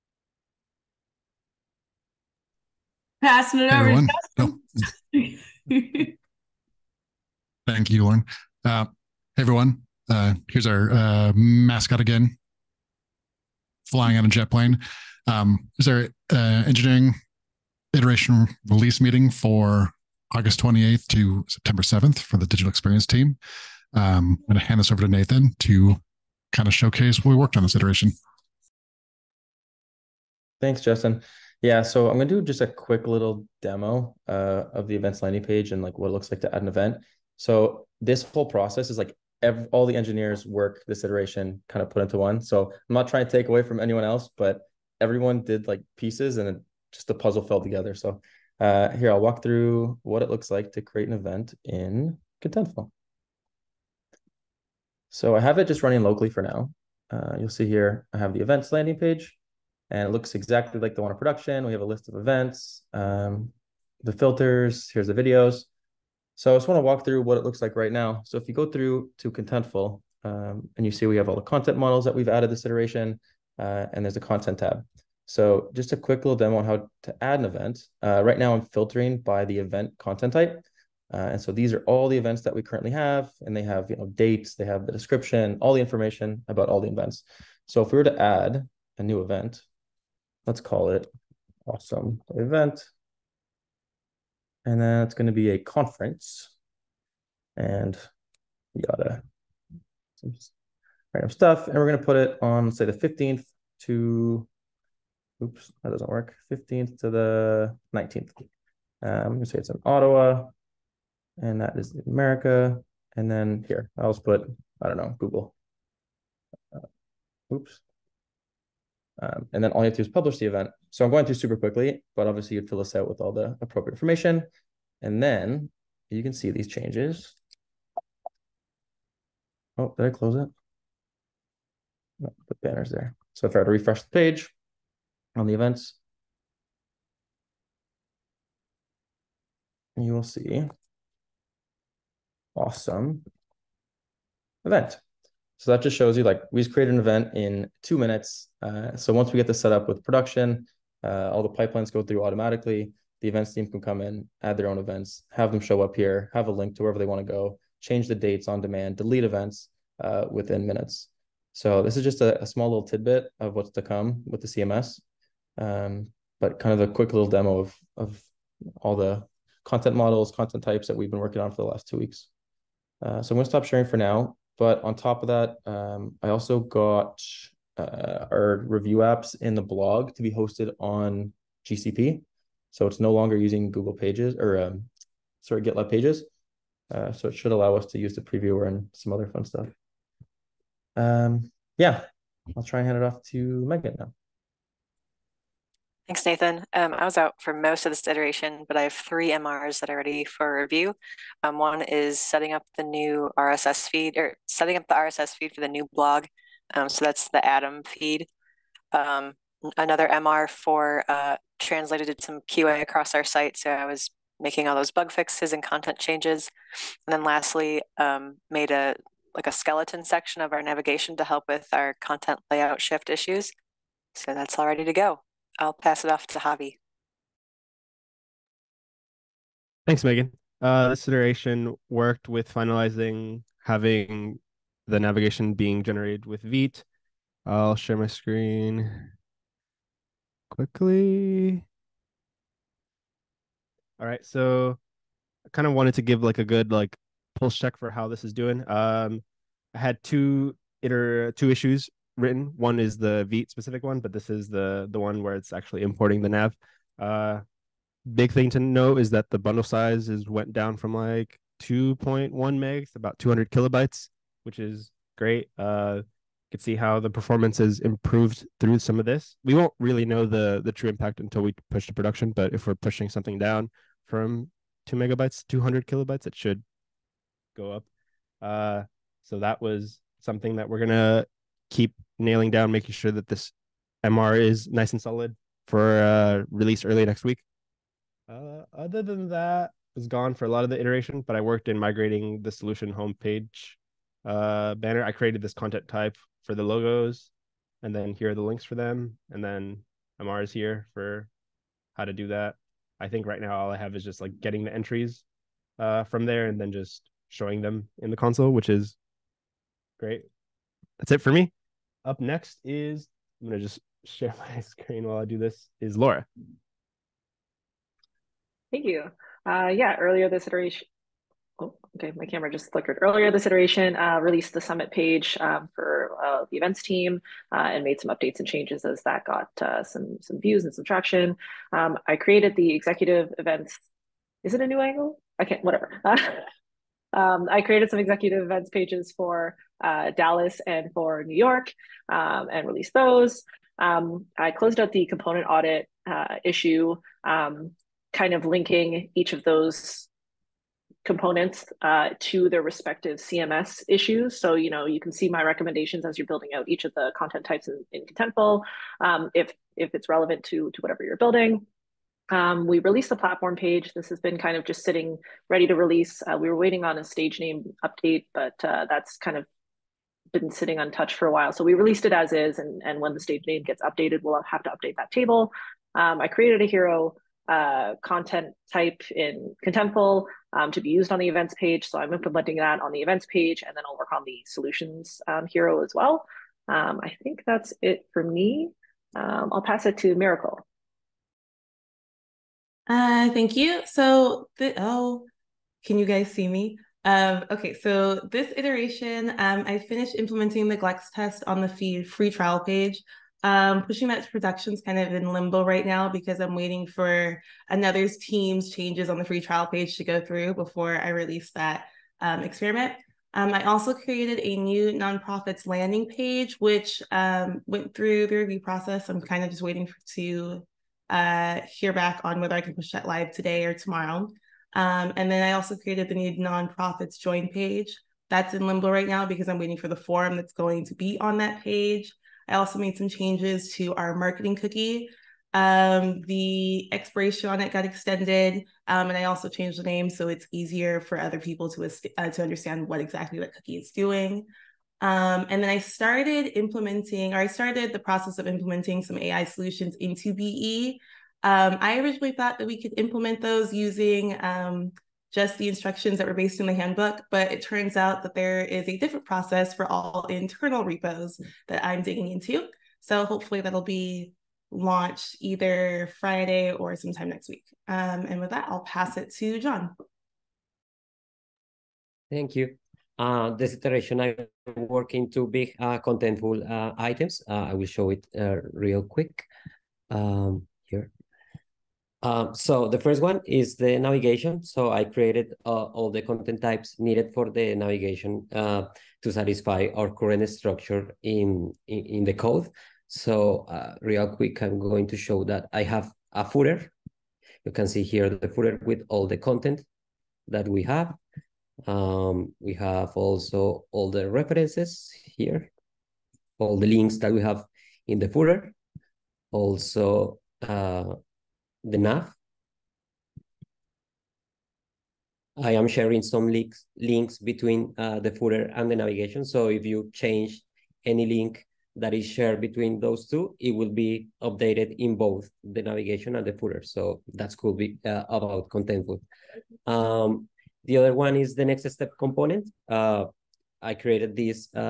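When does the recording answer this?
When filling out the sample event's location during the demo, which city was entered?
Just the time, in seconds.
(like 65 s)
109 s.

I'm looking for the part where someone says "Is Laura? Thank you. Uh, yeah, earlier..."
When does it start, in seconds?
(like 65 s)
315 s.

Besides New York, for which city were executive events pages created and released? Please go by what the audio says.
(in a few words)
Dallas.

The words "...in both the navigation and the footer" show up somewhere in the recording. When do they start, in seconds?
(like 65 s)
524 s.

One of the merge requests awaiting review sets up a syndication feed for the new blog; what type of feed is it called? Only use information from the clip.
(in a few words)
Atom feed.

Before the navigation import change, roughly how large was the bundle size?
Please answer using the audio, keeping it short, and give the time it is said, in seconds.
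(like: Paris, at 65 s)
2.1 megs, at 261 s.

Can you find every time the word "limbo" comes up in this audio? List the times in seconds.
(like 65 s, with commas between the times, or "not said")
405 s, 428 s.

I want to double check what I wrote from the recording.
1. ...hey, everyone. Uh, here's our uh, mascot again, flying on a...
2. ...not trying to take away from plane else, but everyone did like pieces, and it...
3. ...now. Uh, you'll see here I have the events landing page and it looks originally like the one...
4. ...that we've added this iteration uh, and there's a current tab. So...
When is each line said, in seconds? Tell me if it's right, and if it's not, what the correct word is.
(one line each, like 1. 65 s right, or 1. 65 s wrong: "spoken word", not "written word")
1. 9 s right
2. 42 s wrong: "anyone", not "plane"
3. 56 s wrong: "exactly", not "originally"
4. 72 s wrong: "content", not "current".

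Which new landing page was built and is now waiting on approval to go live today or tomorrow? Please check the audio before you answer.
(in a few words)
nonprofits landing page.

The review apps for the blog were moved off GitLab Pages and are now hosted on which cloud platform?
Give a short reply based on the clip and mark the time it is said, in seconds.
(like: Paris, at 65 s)
GCP, at 181 s.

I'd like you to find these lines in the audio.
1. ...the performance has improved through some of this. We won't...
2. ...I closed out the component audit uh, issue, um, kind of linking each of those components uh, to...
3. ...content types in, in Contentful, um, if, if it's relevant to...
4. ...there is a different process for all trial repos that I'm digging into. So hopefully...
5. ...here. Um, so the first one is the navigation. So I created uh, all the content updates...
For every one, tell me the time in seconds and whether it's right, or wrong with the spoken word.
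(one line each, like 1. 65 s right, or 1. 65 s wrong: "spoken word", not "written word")
1. 266 s right
2. 344 s right
3. 357 s right
4. 458 s wrong: "internal", not "trial"
5. 480 s wrong: "types", not "updates".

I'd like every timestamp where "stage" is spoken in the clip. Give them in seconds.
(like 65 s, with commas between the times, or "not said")
367 s, 373 s.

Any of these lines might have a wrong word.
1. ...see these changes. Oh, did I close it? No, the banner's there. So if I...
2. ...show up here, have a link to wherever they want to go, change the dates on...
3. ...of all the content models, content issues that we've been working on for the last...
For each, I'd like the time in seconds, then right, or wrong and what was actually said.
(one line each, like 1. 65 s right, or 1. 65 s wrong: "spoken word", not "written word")
1. 126 s right
2. 155 s right
3. 167 s wrong: "types", not "issues".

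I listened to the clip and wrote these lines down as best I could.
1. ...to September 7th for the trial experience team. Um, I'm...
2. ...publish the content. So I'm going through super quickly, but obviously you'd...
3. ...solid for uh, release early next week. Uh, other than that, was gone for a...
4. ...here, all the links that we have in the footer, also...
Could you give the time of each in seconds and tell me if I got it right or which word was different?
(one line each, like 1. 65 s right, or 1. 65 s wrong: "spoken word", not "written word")
1. 21 s wrong: "digital", not "trial"
2. 120 s wrong: "event", not "content"
3. 285 s right
4. 505 s right.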